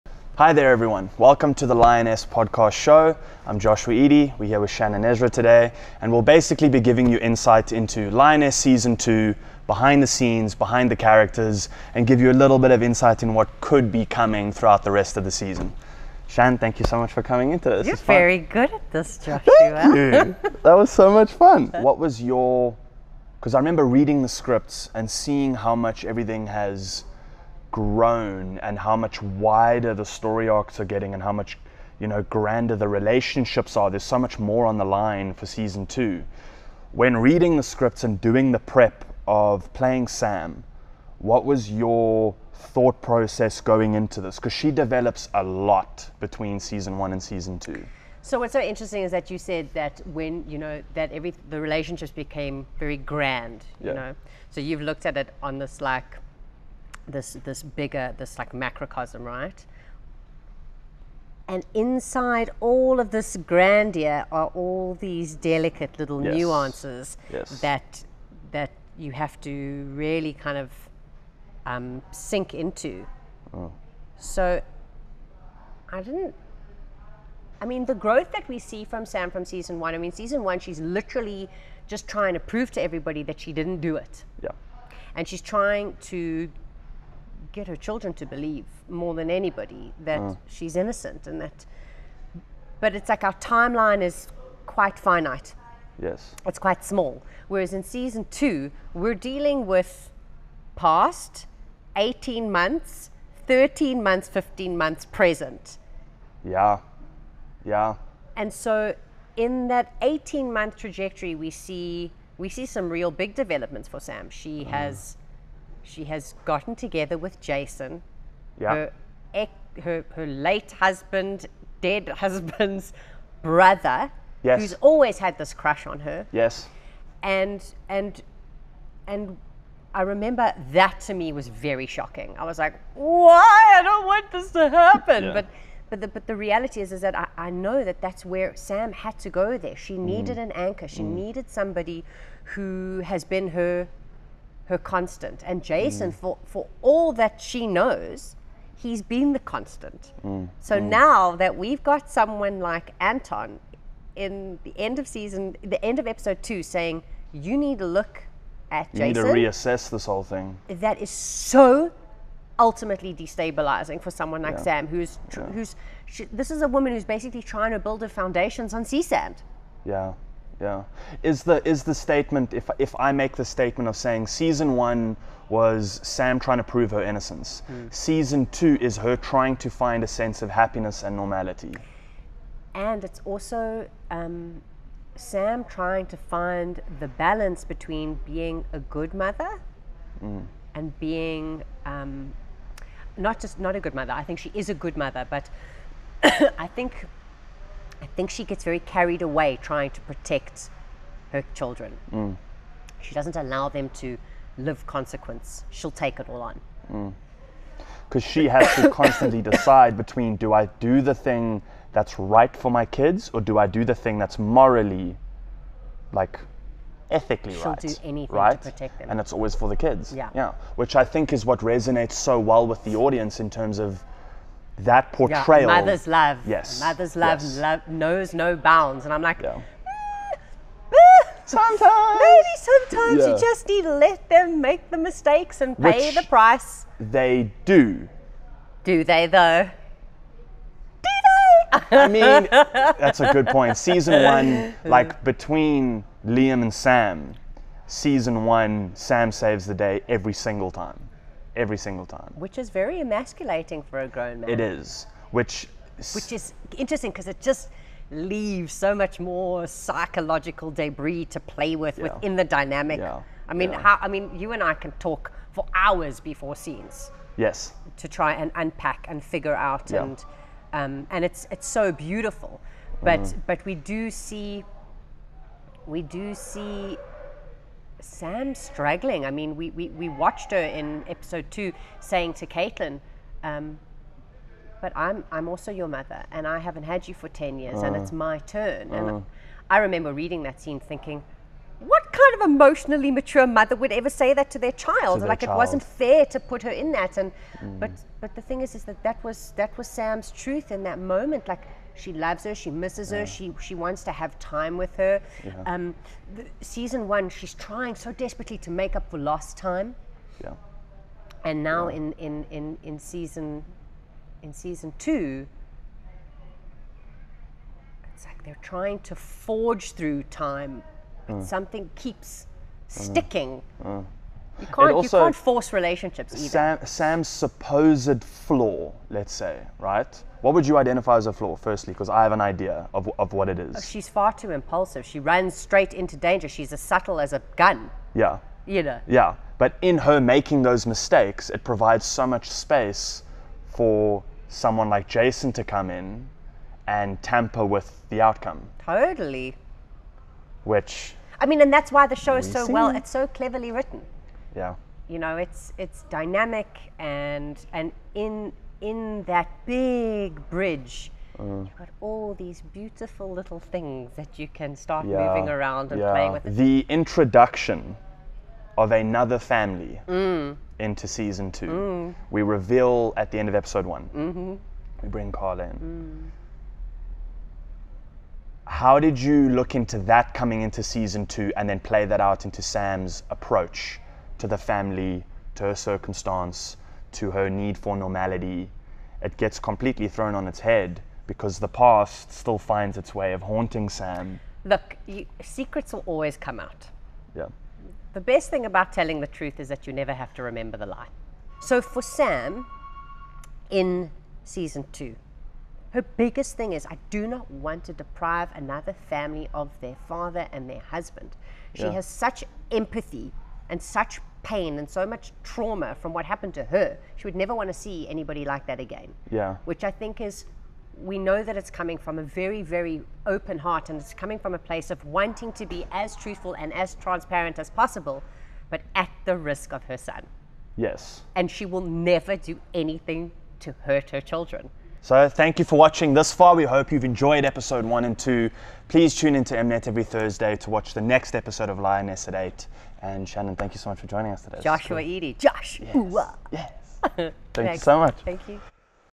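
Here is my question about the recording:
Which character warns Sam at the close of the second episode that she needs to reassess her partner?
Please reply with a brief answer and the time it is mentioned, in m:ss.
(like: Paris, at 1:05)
Anton, at 2:32.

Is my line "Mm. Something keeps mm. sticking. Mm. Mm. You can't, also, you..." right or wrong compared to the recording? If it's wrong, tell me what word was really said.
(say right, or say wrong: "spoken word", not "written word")
right.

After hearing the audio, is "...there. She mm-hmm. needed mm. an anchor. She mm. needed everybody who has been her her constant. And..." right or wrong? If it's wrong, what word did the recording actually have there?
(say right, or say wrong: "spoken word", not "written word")
wrong: "somebody", not "everybody".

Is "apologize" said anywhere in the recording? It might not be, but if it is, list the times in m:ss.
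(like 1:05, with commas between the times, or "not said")
not said.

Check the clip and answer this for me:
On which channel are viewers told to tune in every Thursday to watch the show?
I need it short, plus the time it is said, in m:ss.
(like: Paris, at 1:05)
Mnet, at 7:19.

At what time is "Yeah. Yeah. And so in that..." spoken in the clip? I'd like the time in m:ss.
1:46.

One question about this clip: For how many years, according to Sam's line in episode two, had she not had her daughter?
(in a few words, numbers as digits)
10.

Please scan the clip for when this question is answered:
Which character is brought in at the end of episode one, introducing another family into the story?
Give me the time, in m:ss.
6:15.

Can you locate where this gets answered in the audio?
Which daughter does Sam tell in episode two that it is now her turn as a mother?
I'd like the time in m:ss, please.
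4:42.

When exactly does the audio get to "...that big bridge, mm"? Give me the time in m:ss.
5:59.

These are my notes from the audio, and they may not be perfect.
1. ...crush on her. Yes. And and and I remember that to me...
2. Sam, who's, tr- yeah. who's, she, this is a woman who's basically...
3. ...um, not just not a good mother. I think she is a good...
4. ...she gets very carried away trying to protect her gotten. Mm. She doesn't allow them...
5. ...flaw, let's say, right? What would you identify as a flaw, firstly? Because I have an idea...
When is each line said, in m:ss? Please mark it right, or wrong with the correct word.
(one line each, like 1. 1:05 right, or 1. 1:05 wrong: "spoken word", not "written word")
1. 2:05 right
2. 2:44 right
3. 3:11 right
4. 3:18 wrong: "children", not "gotten"
5. 5:28 right.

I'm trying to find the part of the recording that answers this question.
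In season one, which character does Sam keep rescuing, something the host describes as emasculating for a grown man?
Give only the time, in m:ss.
4:06.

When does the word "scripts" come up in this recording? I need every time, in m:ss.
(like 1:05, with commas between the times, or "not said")
0:24, 0:37.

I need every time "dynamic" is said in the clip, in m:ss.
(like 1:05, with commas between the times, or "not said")
4:22, 5:56.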